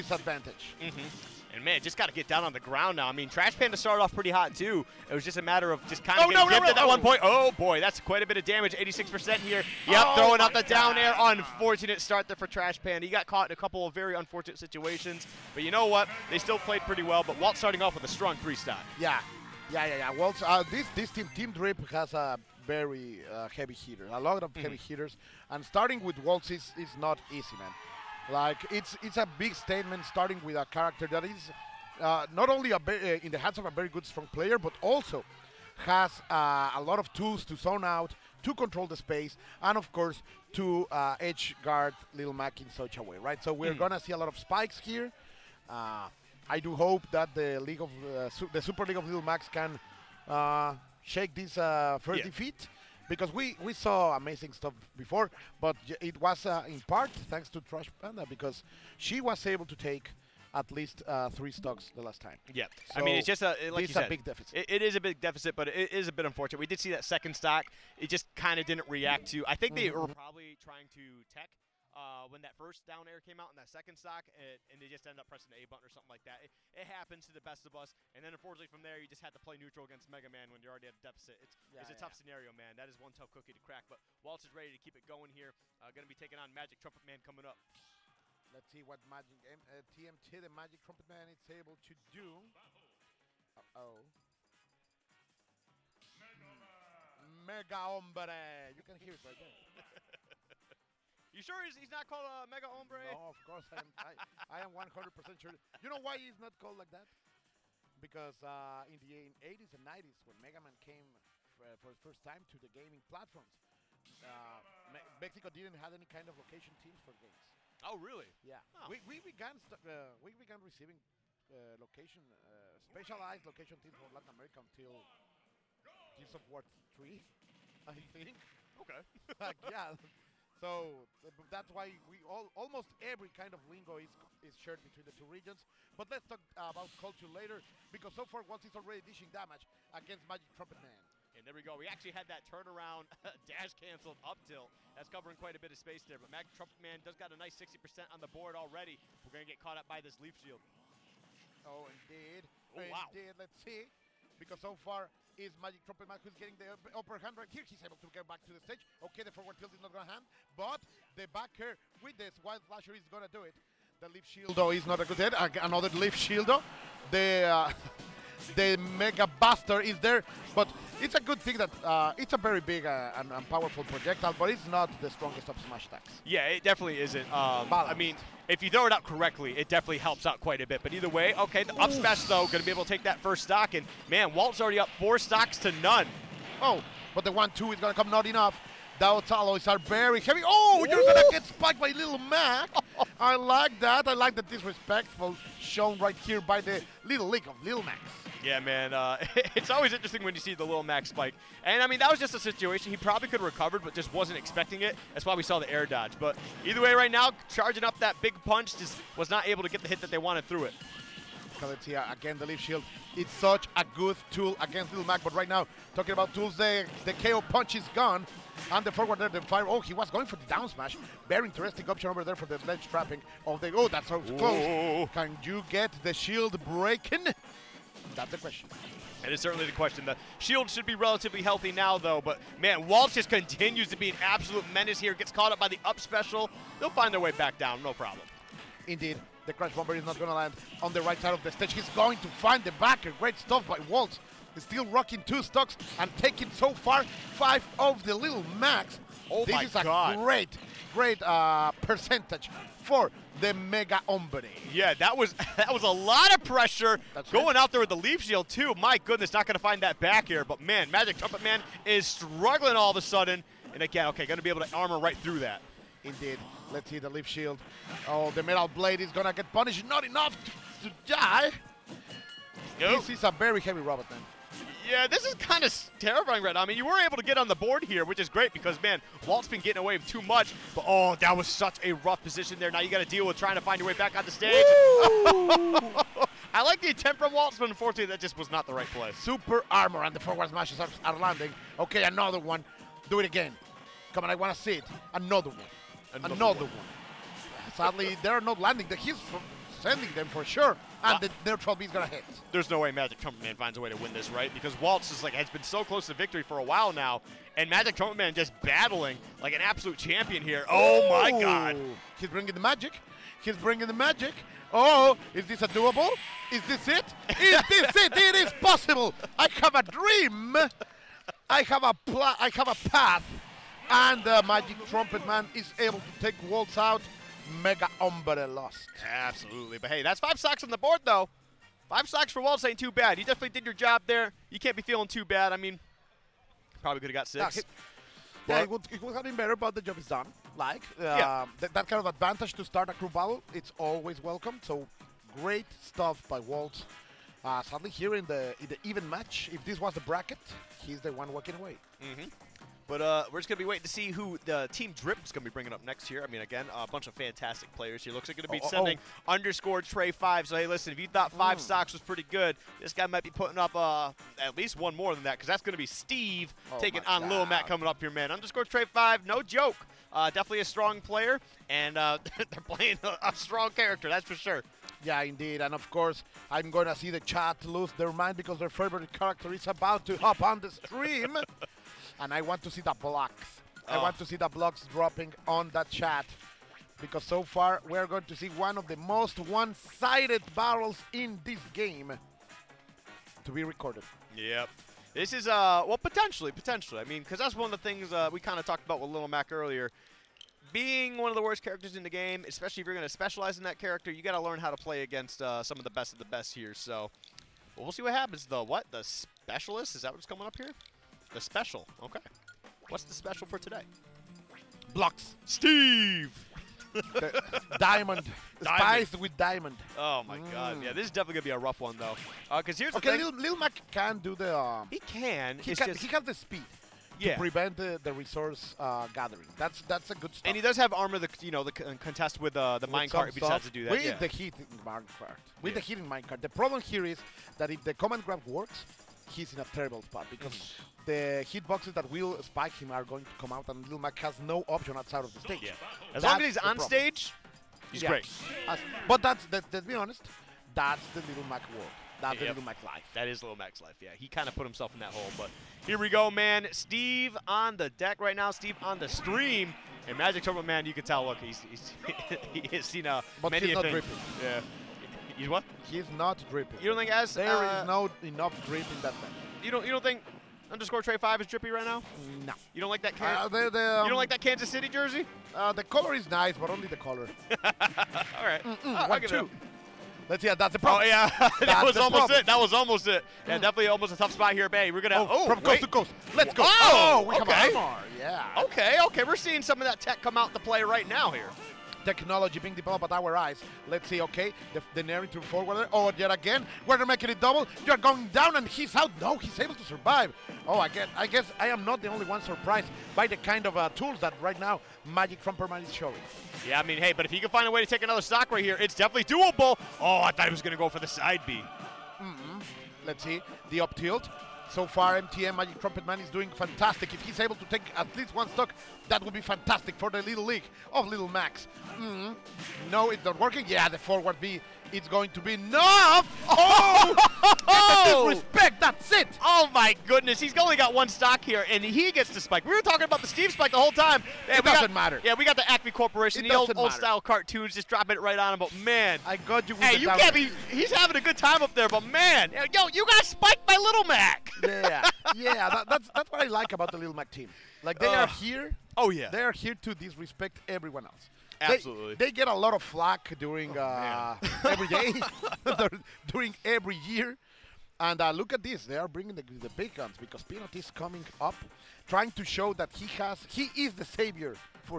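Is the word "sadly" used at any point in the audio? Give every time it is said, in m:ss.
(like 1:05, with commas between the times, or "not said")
4:57, 5:47.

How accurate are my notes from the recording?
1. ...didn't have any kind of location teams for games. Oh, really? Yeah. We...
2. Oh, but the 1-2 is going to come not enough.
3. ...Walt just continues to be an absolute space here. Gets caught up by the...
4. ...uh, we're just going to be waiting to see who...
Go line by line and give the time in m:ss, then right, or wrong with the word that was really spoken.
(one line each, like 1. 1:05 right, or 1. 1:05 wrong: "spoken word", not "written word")
1. 1:55 right
2. 3:06 right
3. 3:52 wrong: "menace", not "space"
4. 5:53 right.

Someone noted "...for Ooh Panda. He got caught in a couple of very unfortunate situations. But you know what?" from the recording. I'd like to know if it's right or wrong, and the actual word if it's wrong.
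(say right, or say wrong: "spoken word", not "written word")
wrong: "Trash", not "Ooh".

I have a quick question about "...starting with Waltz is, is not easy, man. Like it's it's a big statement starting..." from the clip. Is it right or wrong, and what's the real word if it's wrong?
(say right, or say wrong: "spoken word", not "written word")
right.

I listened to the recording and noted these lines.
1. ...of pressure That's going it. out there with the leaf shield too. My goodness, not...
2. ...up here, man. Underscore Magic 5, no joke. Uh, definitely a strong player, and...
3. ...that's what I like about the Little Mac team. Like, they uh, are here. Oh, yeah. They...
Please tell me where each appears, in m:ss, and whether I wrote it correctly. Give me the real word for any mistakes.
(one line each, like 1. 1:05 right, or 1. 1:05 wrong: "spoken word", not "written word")
1. 4:16 right
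2. 6:07 wrong: "Trey", not "Magic"
3. 9:06 right.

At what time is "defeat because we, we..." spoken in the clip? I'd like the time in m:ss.
0:52.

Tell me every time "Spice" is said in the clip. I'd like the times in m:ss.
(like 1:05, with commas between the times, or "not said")
6:58.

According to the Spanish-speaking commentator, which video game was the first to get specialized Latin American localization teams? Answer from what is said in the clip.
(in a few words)
Gears of War 3.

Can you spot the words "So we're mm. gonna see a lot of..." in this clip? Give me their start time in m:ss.
0:43.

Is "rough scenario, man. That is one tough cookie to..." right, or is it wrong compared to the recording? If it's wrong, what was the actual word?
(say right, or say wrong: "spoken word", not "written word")
wrong: "tough", not "rough".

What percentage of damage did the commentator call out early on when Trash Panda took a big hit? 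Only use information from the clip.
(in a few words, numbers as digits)
86%.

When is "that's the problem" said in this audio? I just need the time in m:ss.
8:00.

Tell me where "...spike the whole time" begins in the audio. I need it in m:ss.
8:53.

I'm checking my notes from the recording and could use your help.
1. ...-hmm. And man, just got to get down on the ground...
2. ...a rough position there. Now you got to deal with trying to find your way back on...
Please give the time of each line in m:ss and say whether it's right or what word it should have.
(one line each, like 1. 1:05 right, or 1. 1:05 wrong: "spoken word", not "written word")
1. 0:00 right
2. 4:41 right.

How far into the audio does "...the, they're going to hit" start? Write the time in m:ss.
5:01.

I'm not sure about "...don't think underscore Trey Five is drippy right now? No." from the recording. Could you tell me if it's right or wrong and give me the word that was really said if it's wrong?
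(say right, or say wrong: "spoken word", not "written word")
right.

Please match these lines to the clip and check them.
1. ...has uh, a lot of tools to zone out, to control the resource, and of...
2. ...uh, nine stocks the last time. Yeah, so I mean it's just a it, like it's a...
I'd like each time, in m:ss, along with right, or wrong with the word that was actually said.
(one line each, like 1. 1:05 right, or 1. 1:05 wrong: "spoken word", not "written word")
1. 0:35 wrong: "space", not "resource"
2. 1:01 wrong: "three", not "nine".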